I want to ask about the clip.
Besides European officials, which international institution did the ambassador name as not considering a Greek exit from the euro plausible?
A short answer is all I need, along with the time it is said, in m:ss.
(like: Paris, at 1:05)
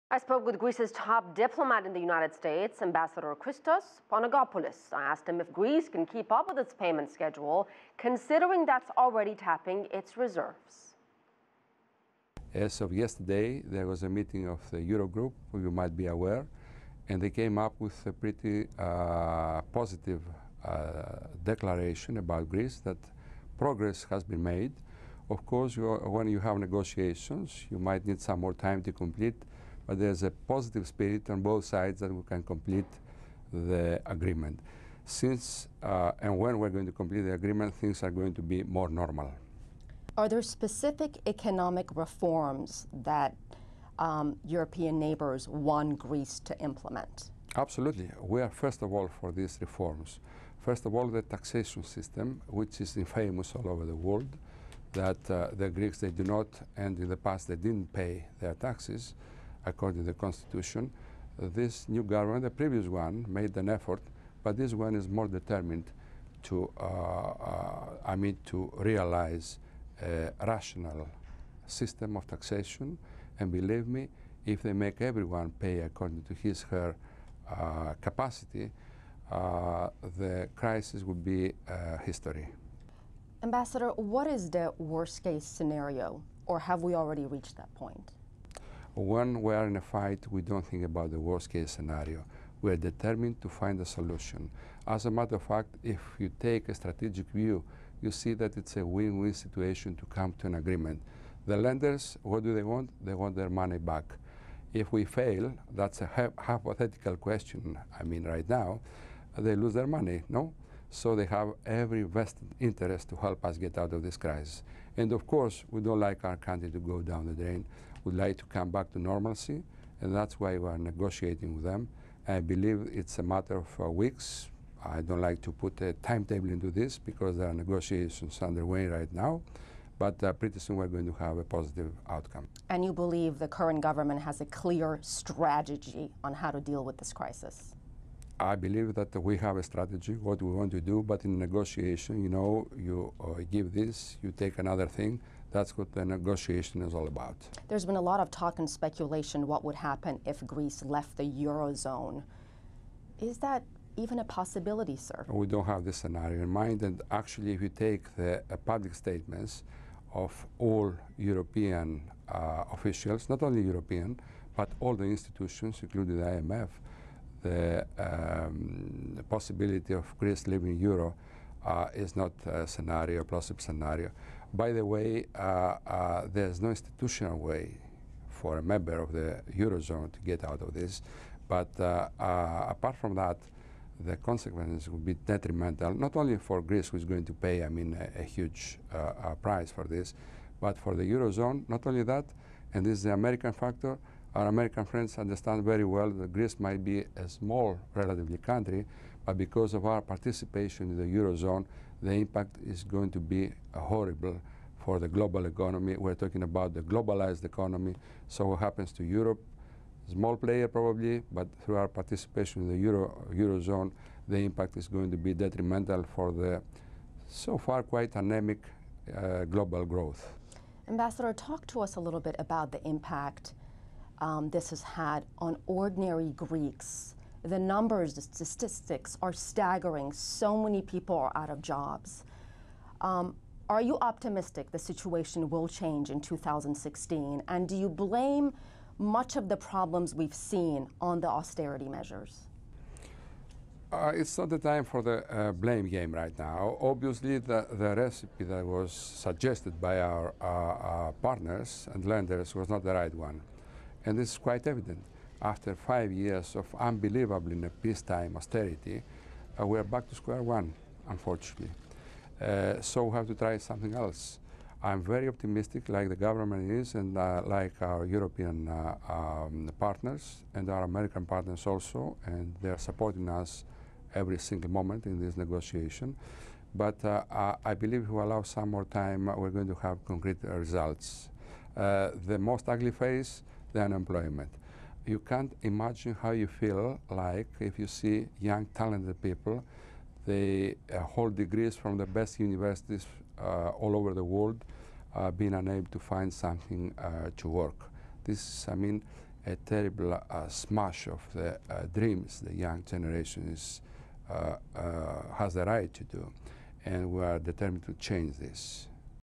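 The IMF, at 2:46.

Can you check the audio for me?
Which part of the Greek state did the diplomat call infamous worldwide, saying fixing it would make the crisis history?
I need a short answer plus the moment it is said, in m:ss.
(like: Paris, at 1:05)
The taxation system, at 0:51.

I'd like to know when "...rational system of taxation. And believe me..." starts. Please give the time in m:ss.
1:10.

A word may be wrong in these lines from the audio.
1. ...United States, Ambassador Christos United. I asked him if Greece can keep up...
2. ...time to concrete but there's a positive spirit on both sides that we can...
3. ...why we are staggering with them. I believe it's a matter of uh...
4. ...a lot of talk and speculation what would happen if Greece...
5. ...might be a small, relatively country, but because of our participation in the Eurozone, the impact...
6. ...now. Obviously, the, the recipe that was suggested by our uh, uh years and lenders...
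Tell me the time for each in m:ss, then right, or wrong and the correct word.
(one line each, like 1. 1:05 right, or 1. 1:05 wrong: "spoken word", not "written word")
1. 0:02 wrong: "Panagopoulos", not "United"
2. 0:28 wrong: "complete", not "concrete"
3. 2:00 wrong: "negotiating", not "staggering"
4. 2:27 right
5. 3:16 right
6. 4:06 wrong: "partners", not "years".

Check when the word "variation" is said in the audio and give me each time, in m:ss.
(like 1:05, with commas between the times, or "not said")
not said.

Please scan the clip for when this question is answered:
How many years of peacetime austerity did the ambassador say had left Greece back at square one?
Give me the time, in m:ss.
4:15.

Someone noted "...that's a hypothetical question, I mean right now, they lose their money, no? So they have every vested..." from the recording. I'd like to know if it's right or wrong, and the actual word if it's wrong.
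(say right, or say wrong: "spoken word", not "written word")
right.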